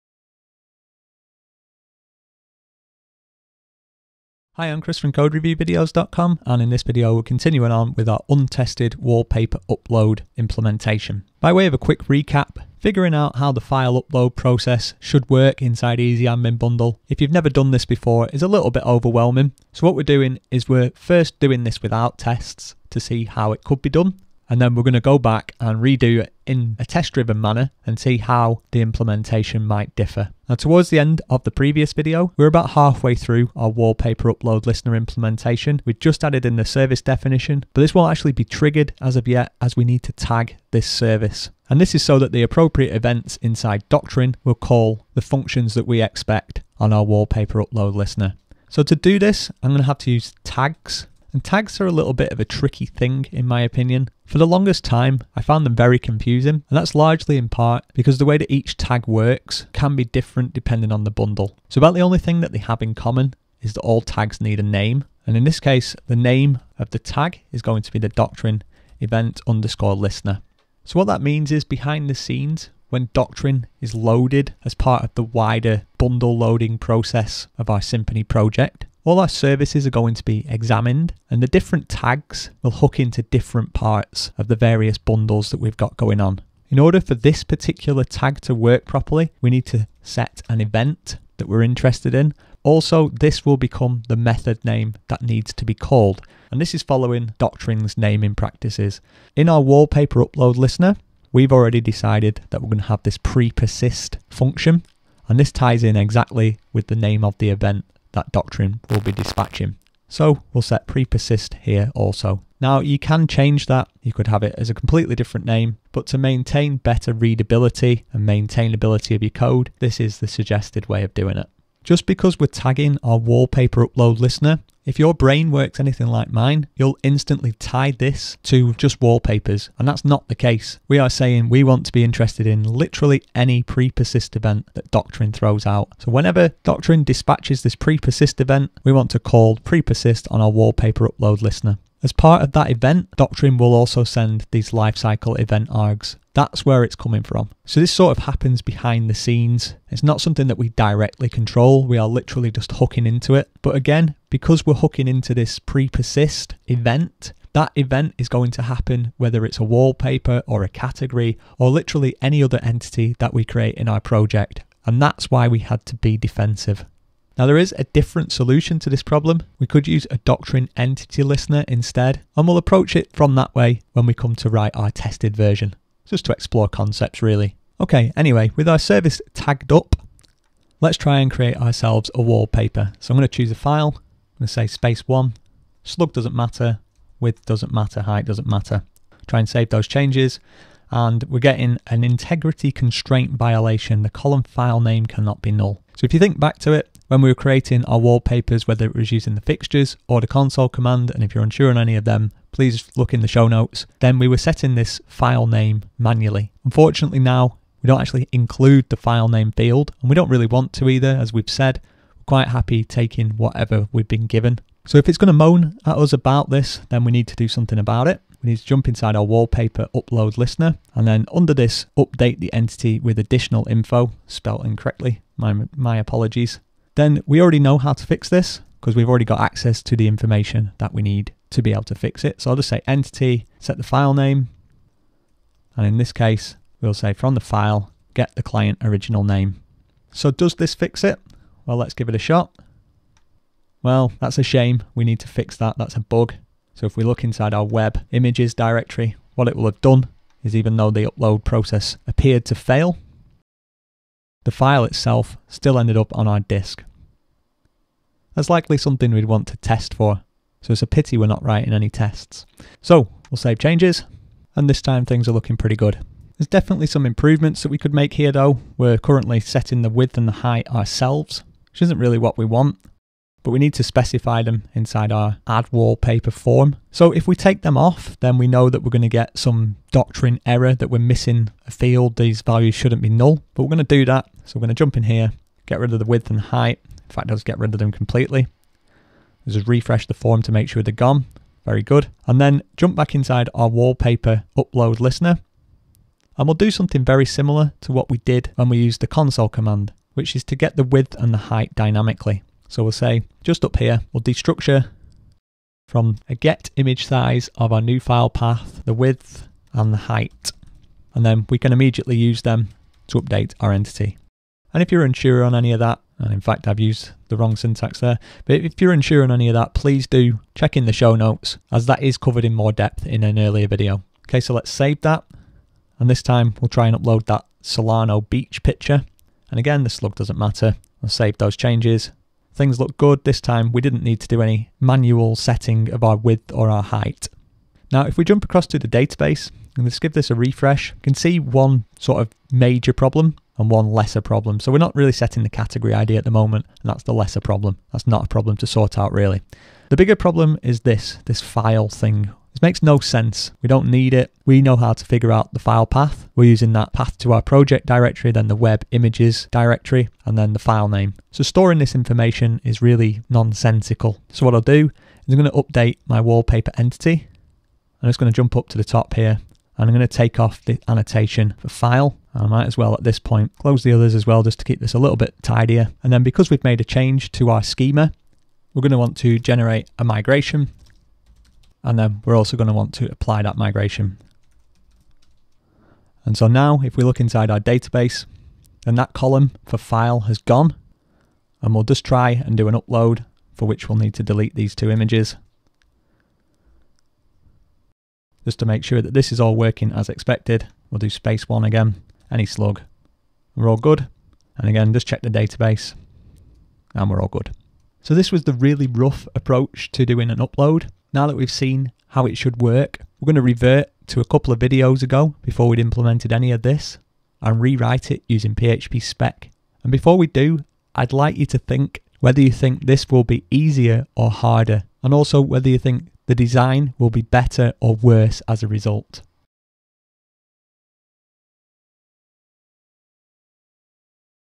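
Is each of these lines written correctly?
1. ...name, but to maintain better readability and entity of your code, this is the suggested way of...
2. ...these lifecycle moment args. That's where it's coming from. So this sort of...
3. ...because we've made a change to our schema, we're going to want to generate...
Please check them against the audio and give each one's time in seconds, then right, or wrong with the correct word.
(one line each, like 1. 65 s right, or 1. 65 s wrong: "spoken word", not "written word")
1. 115 s wrong: "maintainability", not "entity"
2. 144 s wrong: "event", not "moment"
3. 376 s right.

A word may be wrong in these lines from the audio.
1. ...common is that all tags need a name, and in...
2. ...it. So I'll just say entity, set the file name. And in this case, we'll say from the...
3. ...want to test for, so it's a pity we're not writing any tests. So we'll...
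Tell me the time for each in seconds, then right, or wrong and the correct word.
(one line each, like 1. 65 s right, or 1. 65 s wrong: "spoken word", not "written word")
1. 62 s right
2. 232 s right
3. 259 s right.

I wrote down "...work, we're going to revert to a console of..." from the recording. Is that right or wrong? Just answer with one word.
wrong.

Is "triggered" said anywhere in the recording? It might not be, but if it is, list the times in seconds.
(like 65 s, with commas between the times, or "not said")
38 s.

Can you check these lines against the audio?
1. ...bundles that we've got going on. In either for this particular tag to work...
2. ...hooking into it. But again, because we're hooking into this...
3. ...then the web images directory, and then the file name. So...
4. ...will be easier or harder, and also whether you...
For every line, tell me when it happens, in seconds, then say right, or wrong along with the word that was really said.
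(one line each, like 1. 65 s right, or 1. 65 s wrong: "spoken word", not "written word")
1. 84 s wrong: "order", not "either"
2. 152 s right
3. 358 s right
4. 423 s right.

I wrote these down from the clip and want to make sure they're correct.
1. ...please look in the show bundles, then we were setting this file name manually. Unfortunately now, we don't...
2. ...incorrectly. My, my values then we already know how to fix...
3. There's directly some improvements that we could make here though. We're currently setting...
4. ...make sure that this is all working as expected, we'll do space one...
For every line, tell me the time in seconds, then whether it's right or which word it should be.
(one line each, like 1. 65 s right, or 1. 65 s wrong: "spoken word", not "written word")
1. 202 s wrong: "notes", not "bundles"
2. 224 s wrong: "apologies", not "values"
3. 266 s wrong: "definitely", not "directly"
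4. 398 s right.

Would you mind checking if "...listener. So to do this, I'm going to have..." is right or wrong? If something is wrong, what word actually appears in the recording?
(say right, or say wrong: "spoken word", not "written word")
right.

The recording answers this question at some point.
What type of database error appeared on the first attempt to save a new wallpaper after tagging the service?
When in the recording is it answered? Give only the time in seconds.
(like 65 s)
192 s.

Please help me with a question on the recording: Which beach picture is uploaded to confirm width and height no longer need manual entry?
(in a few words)
Solano Beach.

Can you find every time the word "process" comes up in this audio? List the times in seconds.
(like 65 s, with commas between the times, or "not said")
14 s, 76 s, 251 s.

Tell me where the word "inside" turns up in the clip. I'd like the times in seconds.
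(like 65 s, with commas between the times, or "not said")
15 s, 43 s, 218 s, 247 s, 274 s, 293 s, 387 s.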